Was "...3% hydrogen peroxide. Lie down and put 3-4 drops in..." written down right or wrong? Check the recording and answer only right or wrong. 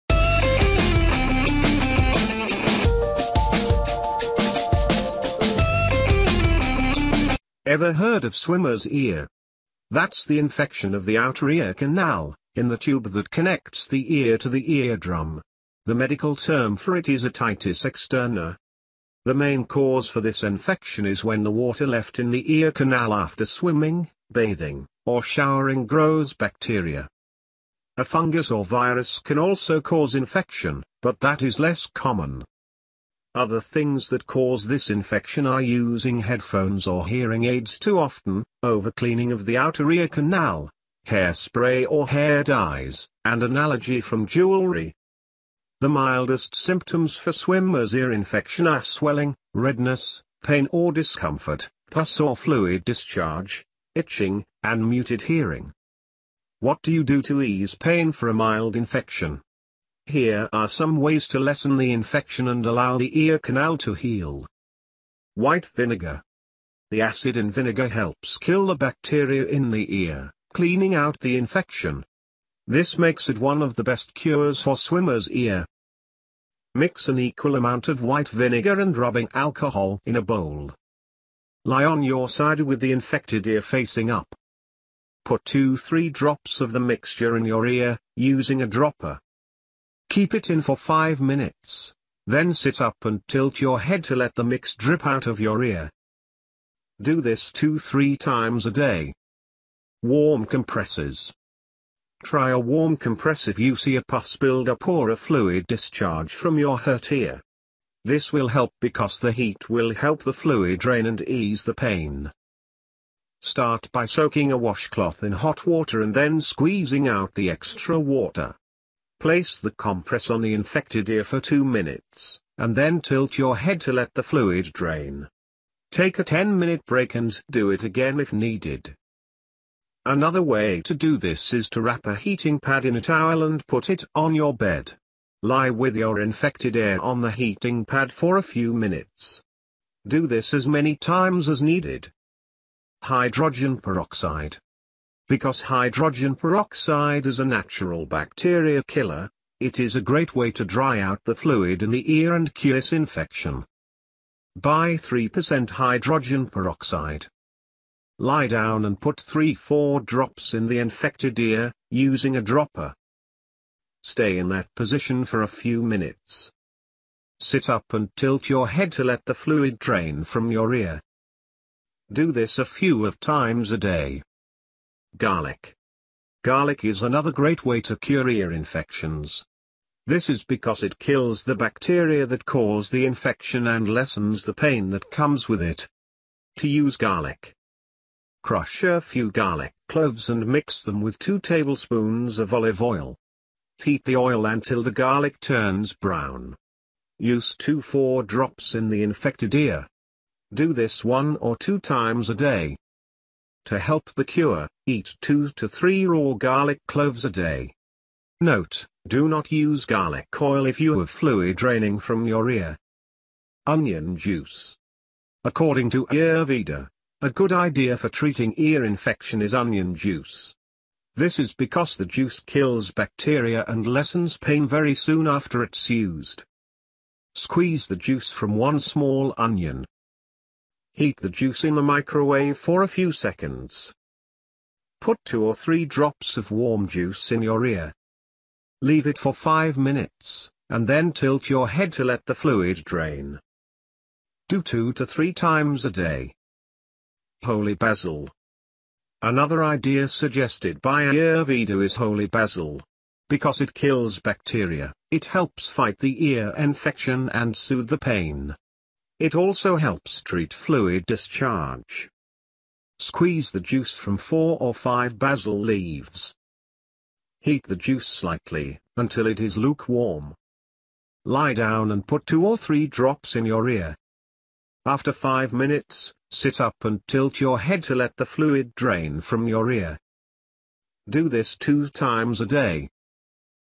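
right.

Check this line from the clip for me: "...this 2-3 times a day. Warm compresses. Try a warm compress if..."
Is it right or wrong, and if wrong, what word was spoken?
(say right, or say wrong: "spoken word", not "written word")
right.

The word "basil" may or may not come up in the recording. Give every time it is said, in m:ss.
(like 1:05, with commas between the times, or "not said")
4:07, 4:12, 4:25.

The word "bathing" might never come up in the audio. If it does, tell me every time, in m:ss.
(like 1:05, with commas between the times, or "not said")
0:24.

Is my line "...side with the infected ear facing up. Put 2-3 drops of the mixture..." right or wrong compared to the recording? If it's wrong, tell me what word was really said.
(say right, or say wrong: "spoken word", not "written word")
right.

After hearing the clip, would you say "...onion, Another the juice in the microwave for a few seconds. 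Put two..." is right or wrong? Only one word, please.
wrong.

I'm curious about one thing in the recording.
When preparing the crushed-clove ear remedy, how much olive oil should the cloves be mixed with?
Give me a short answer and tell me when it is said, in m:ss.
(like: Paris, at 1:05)
2 tablespoons, at 3:11.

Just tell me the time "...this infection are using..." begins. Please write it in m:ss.
0:34.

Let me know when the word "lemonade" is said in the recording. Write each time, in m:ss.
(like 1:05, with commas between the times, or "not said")
not said.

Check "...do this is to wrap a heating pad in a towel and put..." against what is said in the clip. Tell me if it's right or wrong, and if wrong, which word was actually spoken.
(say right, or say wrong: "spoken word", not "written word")
right.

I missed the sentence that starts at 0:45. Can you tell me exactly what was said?
The mildest symptoms for swimmer's ear infection are swelling, redness, pain or discomfort, pus or fluid discharge, itching, and muted hearing.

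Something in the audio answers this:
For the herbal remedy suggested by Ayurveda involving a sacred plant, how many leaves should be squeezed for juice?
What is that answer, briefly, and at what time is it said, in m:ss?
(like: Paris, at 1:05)
4 or 5, at 4:24.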